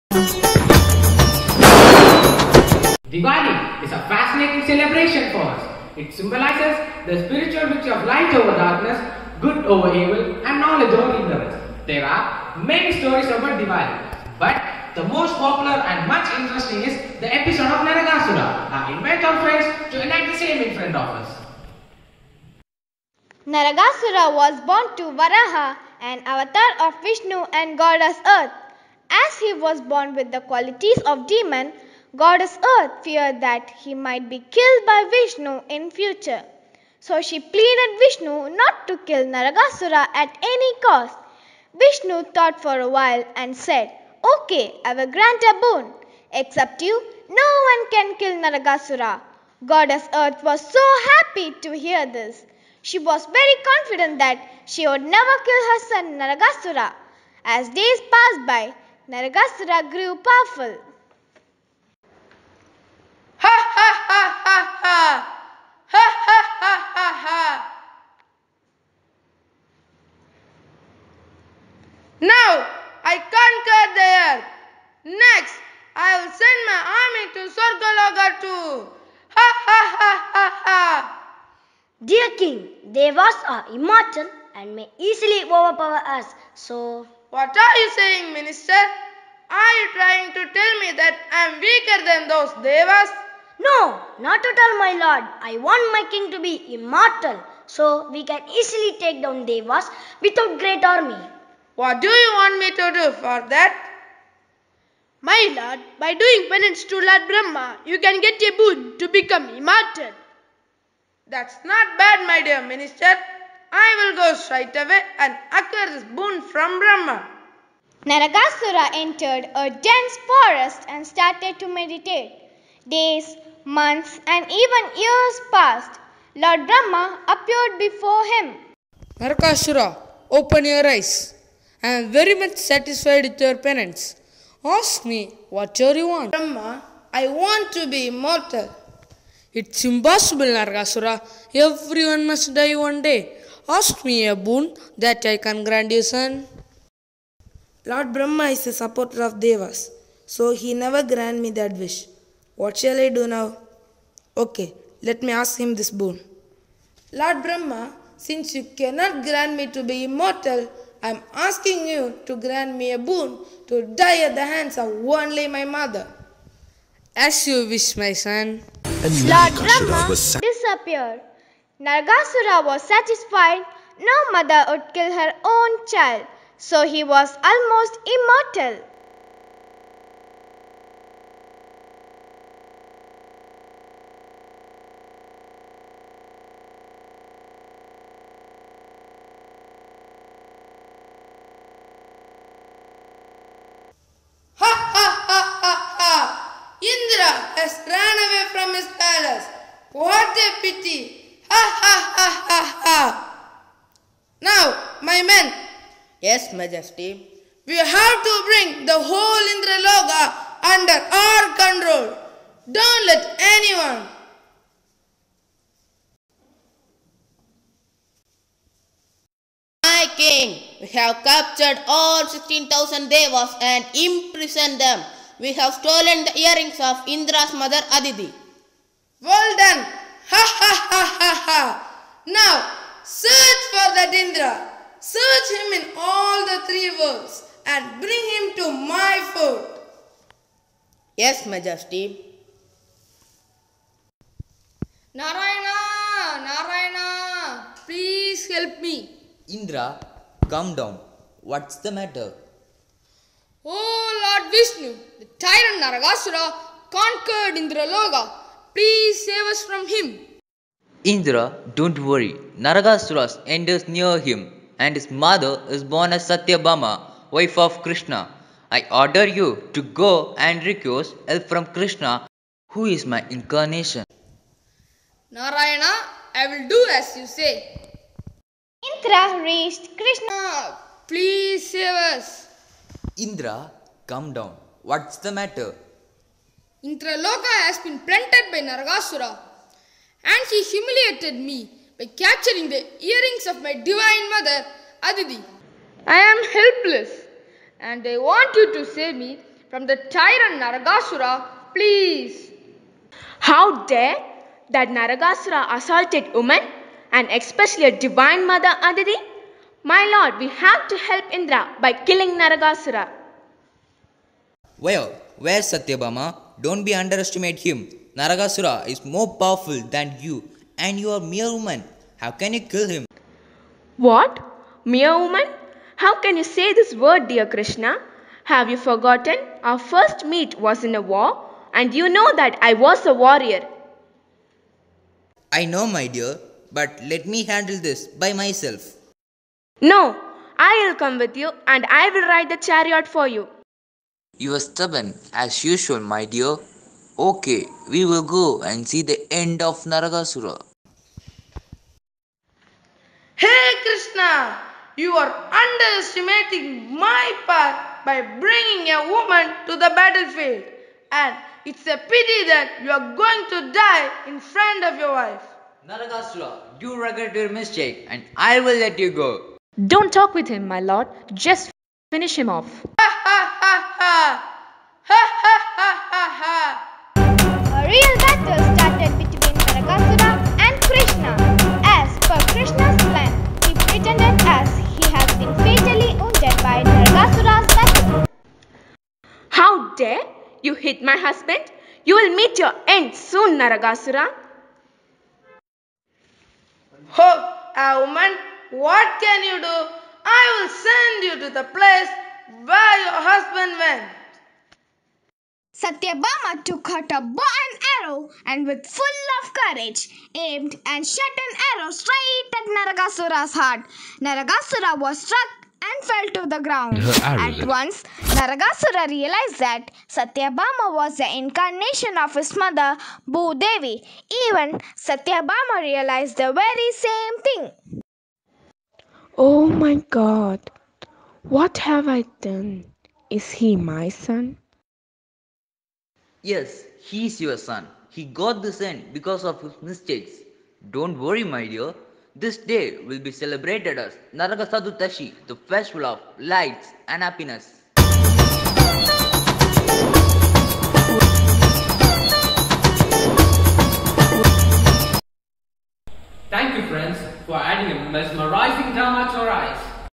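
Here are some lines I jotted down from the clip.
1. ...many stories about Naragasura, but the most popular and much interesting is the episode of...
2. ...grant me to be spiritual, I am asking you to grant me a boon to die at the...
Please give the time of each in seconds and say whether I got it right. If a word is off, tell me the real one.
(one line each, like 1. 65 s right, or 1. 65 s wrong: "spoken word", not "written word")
1. 12 s wrong: "Diwali", not "Naragasura"
2. 159 s wrong: "immortal", not "spiritual".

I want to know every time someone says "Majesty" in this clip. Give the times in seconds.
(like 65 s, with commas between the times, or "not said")
206 s, 241 s.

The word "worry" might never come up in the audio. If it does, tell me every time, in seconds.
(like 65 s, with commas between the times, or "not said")
261 s, 441 s.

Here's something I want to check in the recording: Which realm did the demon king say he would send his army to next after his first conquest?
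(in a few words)
Sorgaloga.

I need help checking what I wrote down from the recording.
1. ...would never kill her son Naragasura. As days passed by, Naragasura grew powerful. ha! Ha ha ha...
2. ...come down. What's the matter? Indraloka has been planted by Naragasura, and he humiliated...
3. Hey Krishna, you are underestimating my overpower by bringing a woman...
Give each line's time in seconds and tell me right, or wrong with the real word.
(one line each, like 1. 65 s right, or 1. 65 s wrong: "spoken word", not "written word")
1. 54 s right
2. 284 s right
3. 353 s wrong: "power", not "overpower".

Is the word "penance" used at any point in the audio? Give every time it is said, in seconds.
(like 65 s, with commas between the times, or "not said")
106 s, 133 s.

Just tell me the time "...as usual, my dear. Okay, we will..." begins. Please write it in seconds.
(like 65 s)
345 s.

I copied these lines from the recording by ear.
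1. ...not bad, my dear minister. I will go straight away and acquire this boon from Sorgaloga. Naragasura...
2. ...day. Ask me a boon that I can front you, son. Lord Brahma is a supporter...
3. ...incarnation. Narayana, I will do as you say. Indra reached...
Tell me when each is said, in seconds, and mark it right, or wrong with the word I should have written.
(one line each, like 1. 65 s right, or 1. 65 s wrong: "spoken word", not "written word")
1. 111 s wrong: "Brahma", not "Sorgaloga"
2. 143 s wrong: "grant", not "front"
3. 273 s right.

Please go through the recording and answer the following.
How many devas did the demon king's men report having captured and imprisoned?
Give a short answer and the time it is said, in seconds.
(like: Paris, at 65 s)
16,000, at 222 s.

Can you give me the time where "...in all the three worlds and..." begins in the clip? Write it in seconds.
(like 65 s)
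235 s.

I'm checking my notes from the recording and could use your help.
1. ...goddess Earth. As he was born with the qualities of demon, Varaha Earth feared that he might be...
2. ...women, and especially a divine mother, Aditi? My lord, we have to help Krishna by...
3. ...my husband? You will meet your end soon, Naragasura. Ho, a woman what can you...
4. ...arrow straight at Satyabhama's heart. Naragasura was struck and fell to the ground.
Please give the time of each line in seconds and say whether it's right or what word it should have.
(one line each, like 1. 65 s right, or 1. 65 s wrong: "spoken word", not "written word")
1. 27 s wrong: "Goddess", not "Varaha"
2. 306 s wrong: "Indra", not "Krishna"
3. 391 s right
4. 411 s wrong: "Naragasura", not "Satyabhama".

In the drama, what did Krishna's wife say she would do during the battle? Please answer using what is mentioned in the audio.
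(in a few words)
Ride the chariot.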